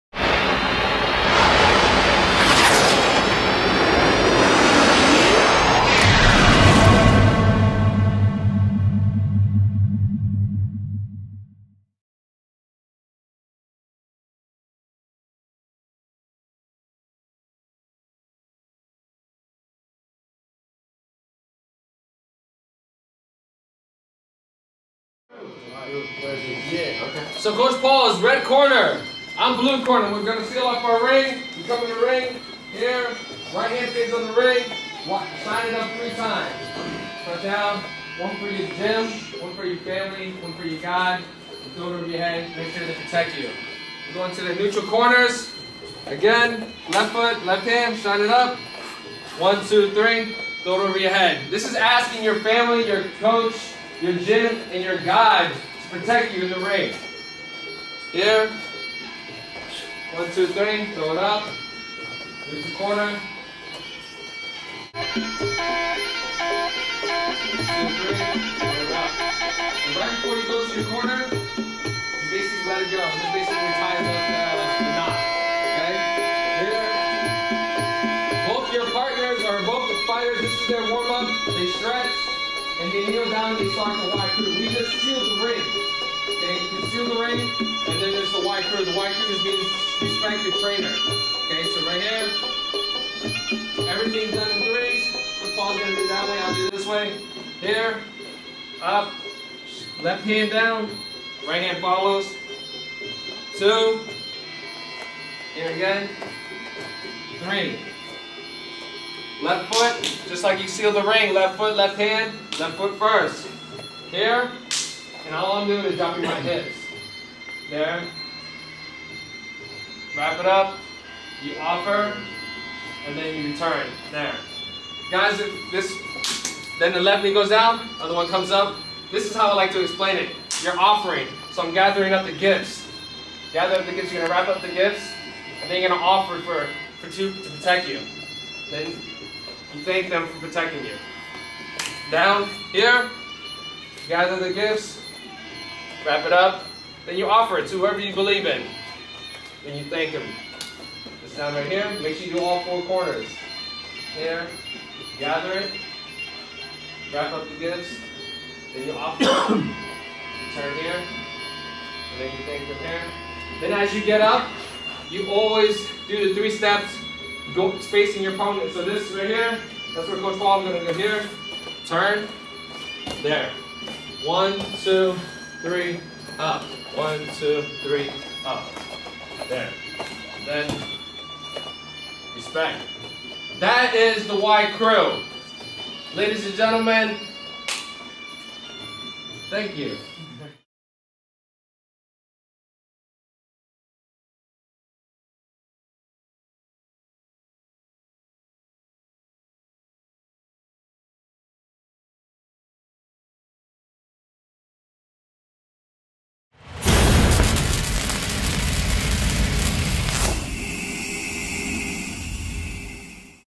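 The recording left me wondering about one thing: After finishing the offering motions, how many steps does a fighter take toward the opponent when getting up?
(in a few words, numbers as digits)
3.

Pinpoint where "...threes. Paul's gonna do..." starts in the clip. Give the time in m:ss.
1:34.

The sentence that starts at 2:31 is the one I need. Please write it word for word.
This time right here, make sure you do all four corners.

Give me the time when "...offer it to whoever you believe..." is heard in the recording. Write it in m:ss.
2:27.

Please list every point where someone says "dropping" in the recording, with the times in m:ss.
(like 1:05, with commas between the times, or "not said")
1:55.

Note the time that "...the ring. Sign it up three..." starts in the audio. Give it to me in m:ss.
0:34.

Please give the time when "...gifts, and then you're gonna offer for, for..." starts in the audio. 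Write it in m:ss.
2:14.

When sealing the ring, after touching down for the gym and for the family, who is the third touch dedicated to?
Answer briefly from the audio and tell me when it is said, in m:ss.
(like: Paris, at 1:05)
Your God, at 0:40.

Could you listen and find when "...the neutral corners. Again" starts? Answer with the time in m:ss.
0:44.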